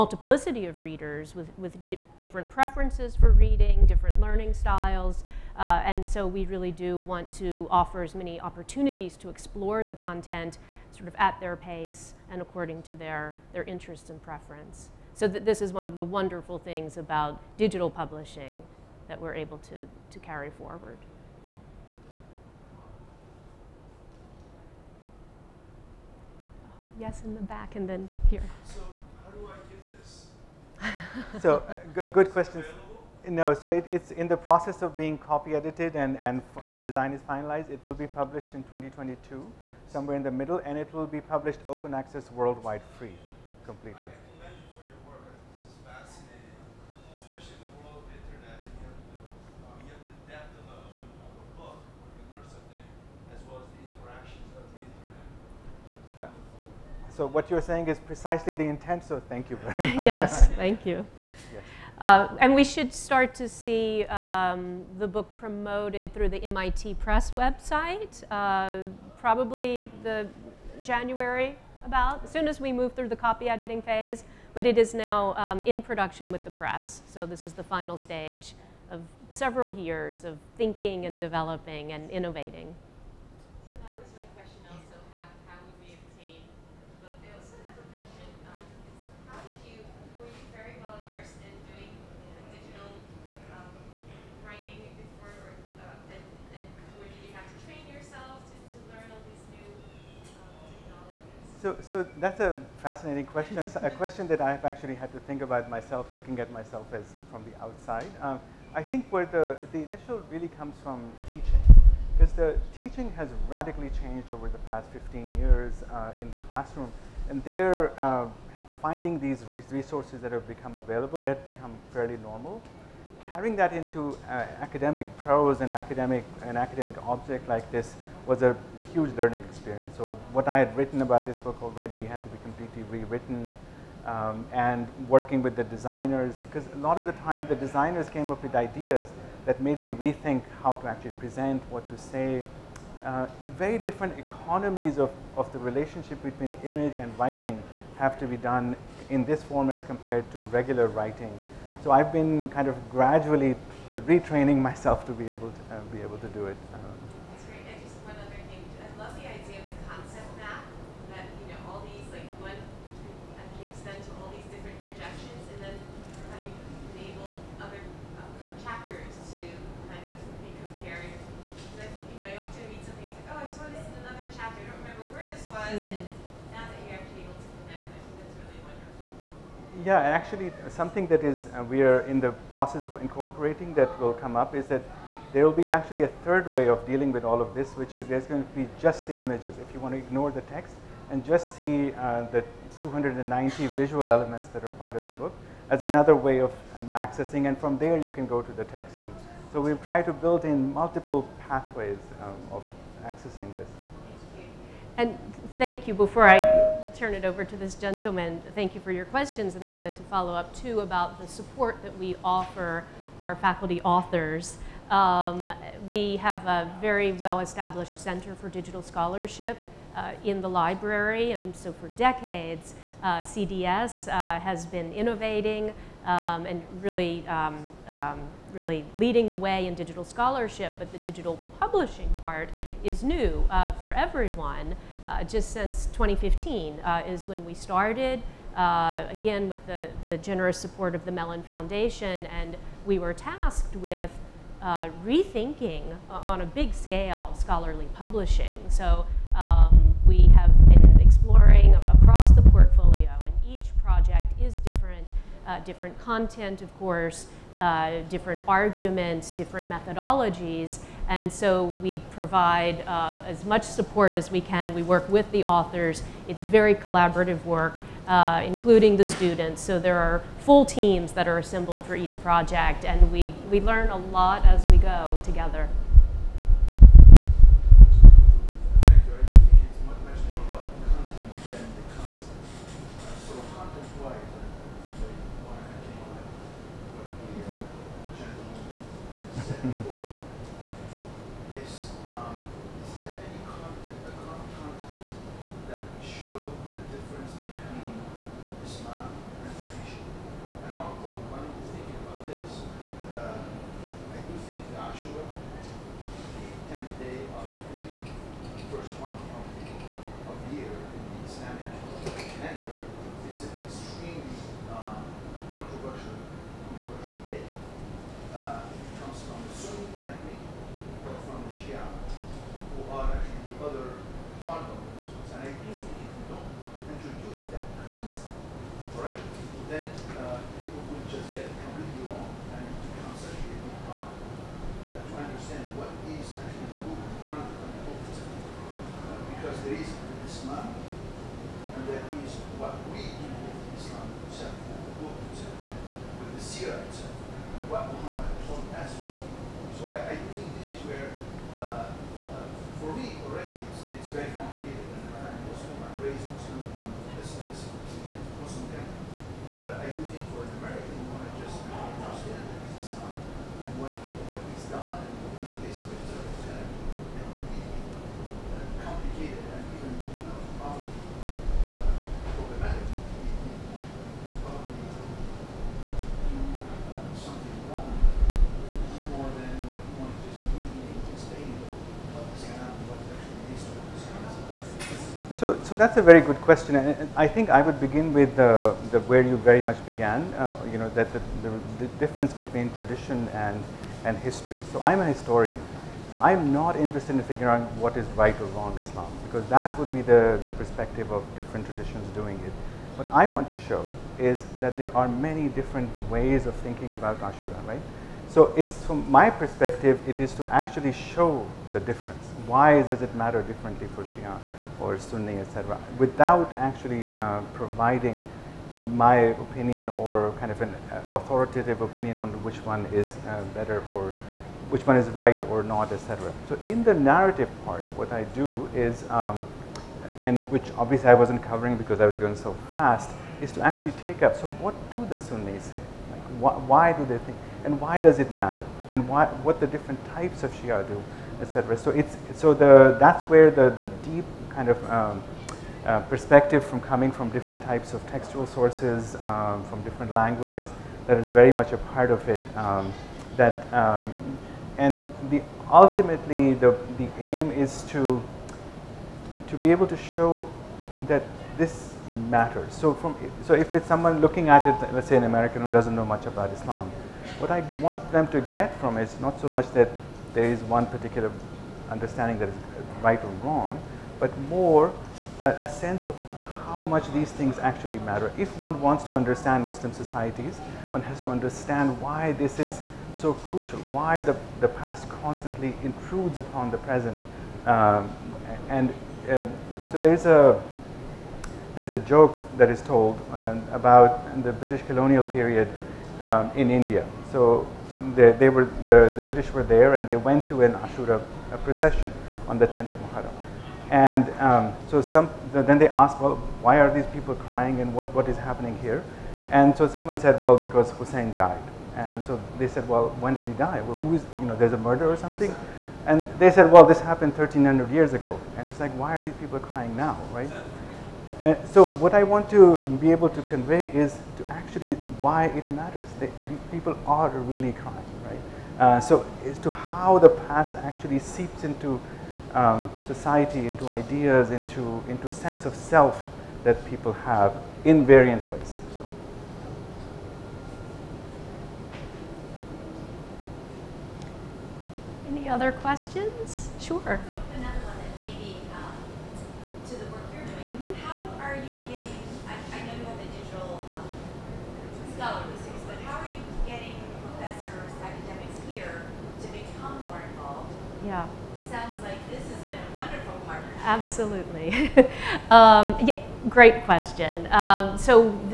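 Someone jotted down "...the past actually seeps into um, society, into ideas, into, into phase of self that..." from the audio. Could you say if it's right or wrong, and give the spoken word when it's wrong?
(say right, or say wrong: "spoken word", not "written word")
wrong: "sense", not "phase".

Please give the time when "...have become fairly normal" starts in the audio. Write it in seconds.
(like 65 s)
121 s.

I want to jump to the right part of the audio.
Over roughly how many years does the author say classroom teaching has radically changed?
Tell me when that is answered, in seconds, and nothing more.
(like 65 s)
114 s.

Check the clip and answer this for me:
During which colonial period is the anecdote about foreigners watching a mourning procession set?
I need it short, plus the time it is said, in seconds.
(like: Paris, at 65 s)
British colonial period, at 494 s.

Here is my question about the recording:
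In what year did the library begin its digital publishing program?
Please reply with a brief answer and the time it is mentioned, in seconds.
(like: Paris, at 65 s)
2015, at 235 s.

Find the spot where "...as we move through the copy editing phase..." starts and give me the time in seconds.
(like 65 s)
72 s.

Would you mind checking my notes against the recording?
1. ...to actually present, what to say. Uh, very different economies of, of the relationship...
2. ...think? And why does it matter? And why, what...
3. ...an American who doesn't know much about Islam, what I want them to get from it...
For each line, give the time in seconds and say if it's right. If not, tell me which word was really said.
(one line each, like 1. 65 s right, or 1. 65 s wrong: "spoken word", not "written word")
1. 140 s right
2. 437 s right
3. 465 s right.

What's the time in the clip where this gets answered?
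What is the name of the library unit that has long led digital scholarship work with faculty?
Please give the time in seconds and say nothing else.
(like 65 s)
217 s.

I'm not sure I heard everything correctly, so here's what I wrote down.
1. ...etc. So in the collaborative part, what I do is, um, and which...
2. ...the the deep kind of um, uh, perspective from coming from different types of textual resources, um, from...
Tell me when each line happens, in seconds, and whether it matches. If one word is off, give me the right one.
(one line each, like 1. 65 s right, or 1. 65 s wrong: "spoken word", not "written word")
1. 425 s wrong: "narrative", not "collaborative"
2. 443 s wrong: "sources", not "resources".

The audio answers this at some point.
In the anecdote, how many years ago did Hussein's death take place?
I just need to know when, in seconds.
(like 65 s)
517 s.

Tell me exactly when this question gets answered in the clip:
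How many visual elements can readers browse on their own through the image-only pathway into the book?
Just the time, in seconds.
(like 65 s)
192 s.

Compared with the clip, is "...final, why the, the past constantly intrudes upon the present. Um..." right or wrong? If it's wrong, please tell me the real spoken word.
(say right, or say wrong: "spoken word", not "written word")
wrong: "crucial", not "final".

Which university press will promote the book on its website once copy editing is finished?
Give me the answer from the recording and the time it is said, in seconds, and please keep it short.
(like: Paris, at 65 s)
MIT Press, at 66 s.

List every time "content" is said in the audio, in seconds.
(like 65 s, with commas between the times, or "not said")
9 s, 255 s.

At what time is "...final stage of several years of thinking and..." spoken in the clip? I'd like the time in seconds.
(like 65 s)
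77 s.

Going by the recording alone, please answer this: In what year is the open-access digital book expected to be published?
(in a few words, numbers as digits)
2022.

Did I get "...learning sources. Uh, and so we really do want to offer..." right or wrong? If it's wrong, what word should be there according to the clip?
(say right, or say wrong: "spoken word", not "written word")
wrong: "styles", not "sources".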